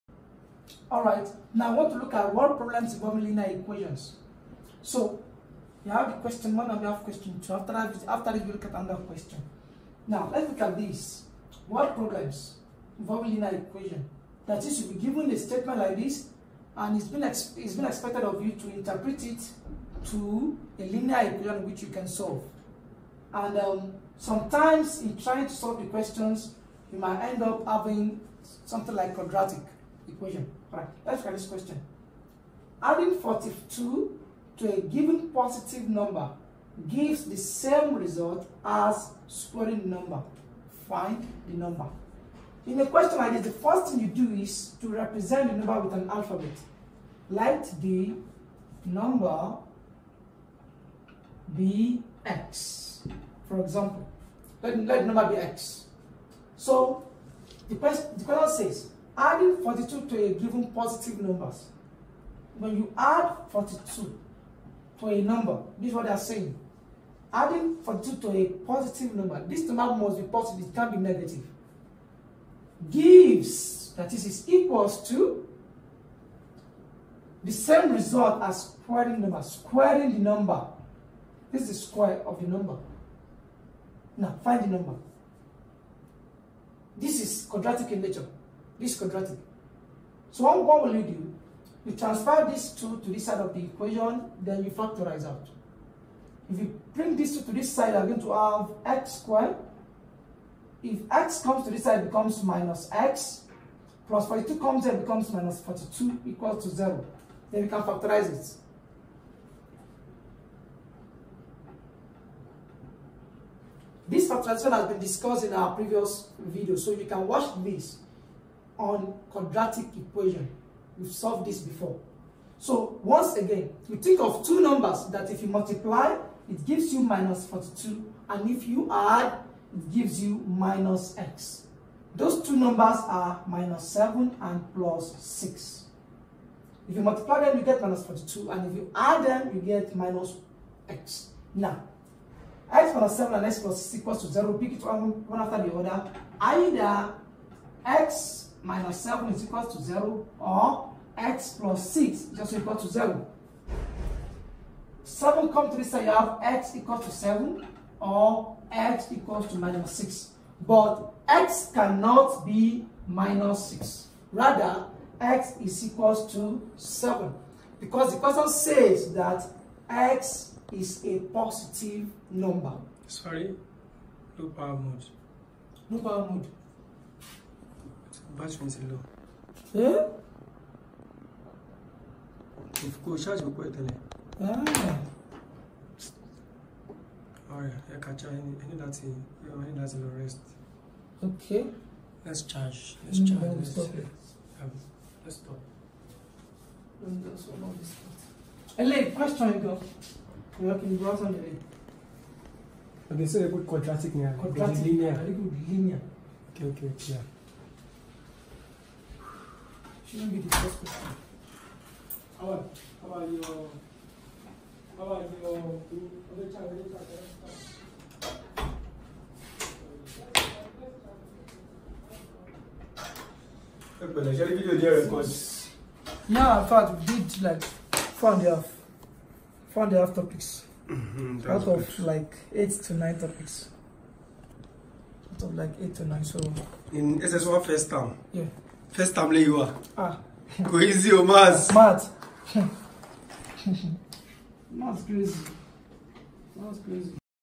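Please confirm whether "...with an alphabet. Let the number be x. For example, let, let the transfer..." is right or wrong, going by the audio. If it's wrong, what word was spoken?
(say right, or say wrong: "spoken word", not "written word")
wrong: "number", not "transfer".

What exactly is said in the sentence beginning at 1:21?
This is the square of the number.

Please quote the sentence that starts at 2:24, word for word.
Pick it one after the other.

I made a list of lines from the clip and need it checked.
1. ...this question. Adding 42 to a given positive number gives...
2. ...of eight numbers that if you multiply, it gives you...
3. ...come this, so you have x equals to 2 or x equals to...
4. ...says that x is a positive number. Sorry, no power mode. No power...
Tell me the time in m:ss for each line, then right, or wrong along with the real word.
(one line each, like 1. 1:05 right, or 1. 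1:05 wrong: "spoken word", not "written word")
1. 0:31 right
2. 2:04 wrong: "two", not "eight"
3. 2:35 wrong: "7", not "2"
4. 2:48 right.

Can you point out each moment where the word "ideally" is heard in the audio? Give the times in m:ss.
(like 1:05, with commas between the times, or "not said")
not said.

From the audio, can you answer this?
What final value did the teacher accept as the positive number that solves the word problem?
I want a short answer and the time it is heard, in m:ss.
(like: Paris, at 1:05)
7, at 2:45.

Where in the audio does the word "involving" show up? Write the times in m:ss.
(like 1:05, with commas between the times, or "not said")
0:02, 0:12.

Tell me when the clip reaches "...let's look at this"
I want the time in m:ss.
0:10.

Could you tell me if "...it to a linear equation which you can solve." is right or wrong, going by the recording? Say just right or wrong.
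right.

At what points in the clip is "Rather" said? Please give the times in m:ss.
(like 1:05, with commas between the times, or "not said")
2:44.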